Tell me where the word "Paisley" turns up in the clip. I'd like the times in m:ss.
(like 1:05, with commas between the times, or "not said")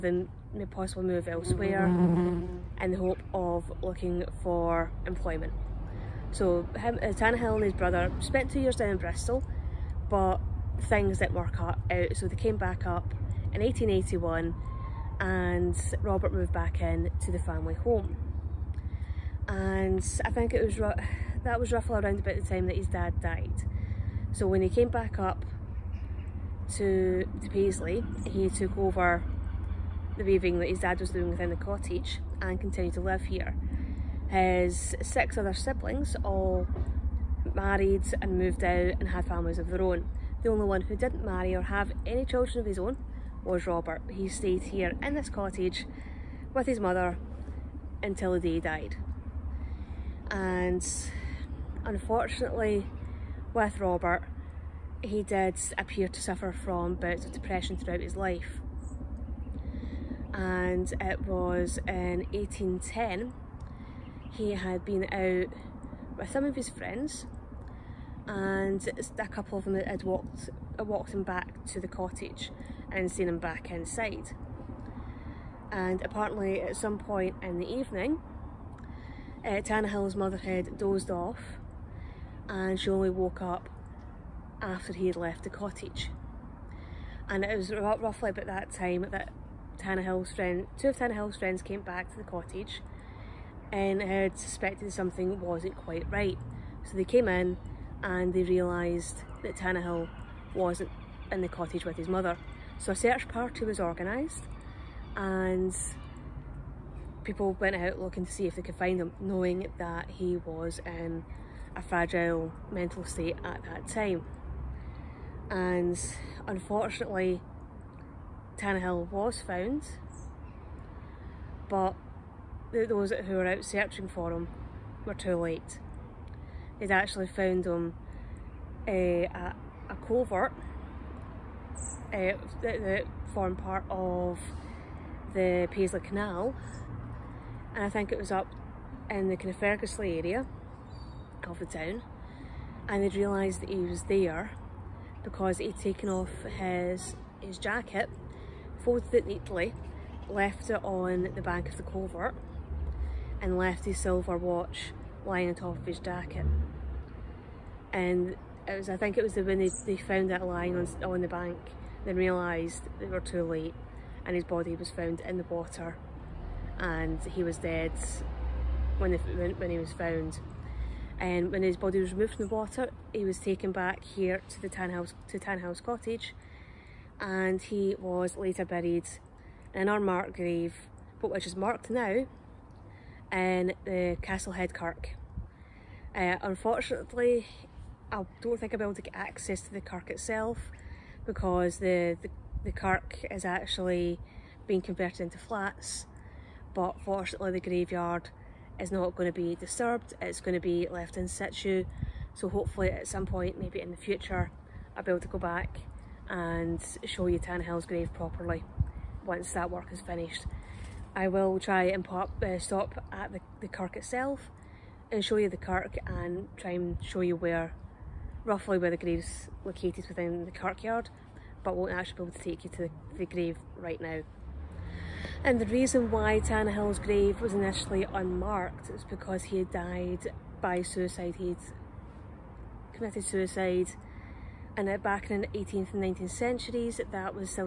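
0:27, 2:15.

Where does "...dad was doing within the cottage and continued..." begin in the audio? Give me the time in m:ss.
0:30.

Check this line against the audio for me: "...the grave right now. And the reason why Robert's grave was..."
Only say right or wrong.
wrong.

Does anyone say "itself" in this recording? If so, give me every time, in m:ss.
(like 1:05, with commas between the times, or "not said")
3:10, 3:33.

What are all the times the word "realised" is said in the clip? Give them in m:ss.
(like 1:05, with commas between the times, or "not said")
1:38, 2:23, 2:42.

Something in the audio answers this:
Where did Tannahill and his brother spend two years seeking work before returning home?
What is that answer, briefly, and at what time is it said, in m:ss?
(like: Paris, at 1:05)
Bristol, at 0:08.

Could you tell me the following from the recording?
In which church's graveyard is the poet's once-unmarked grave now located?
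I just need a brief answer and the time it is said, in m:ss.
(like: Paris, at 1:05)
Castlehead Kirk, at 3:04.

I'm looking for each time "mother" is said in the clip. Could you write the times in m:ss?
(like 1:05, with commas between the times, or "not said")
0:46, 1:20, 1:42.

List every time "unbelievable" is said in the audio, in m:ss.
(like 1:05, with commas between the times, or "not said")
not said.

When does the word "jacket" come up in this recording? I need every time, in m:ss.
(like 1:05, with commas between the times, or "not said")
2:27, 2:35.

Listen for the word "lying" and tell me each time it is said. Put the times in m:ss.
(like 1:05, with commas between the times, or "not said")
2:35, 2:40.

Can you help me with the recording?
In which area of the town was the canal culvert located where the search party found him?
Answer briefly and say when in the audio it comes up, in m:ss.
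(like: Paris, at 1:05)
Ferguslie, at 2:19.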